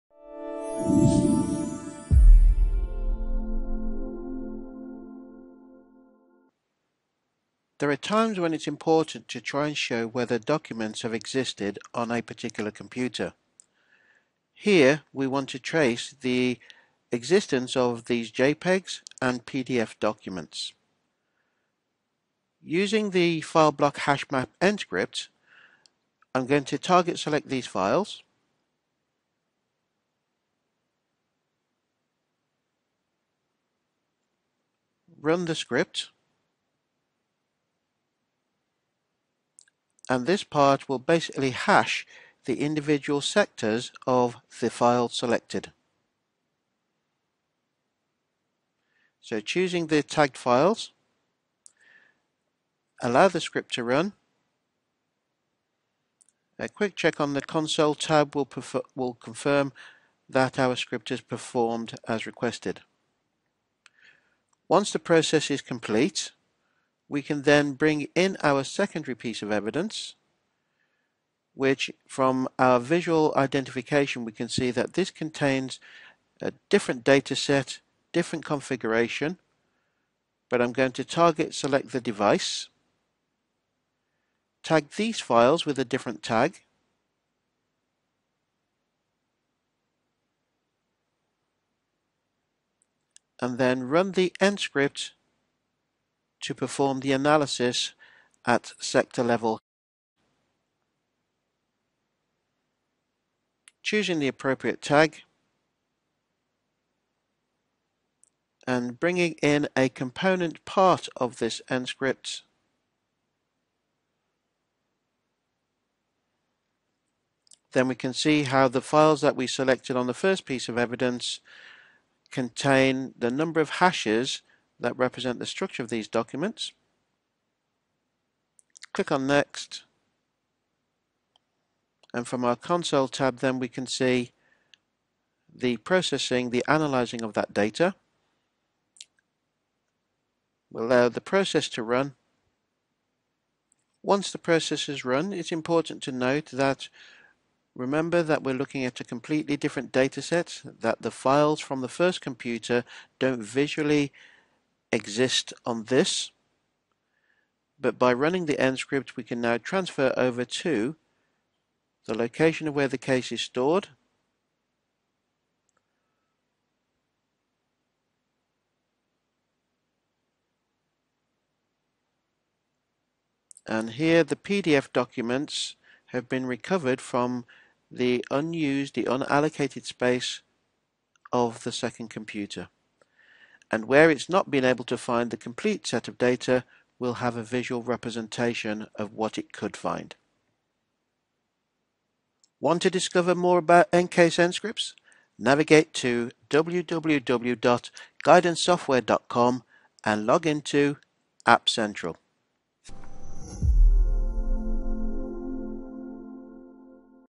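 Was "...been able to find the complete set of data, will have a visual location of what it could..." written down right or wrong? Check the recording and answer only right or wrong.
wrong.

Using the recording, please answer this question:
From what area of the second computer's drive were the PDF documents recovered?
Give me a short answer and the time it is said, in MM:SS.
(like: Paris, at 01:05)
unallocated space, at 02:59.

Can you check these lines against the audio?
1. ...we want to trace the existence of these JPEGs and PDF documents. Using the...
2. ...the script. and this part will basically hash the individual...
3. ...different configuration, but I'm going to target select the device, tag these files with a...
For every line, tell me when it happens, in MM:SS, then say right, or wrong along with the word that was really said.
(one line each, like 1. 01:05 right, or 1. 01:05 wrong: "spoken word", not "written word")
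1. 00:15 right
2. 00:35 right
3. 01:18 right.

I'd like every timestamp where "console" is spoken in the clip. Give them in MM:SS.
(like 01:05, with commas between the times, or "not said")
00:57, 02:12.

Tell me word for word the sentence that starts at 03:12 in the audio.
Want to discover more about EnCase EnScripts?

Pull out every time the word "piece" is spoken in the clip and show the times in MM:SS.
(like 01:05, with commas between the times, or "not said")
01:09, 02:00.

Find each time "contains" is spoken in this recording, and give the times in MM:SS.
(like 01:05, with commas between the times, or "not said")
01:15, 02:02.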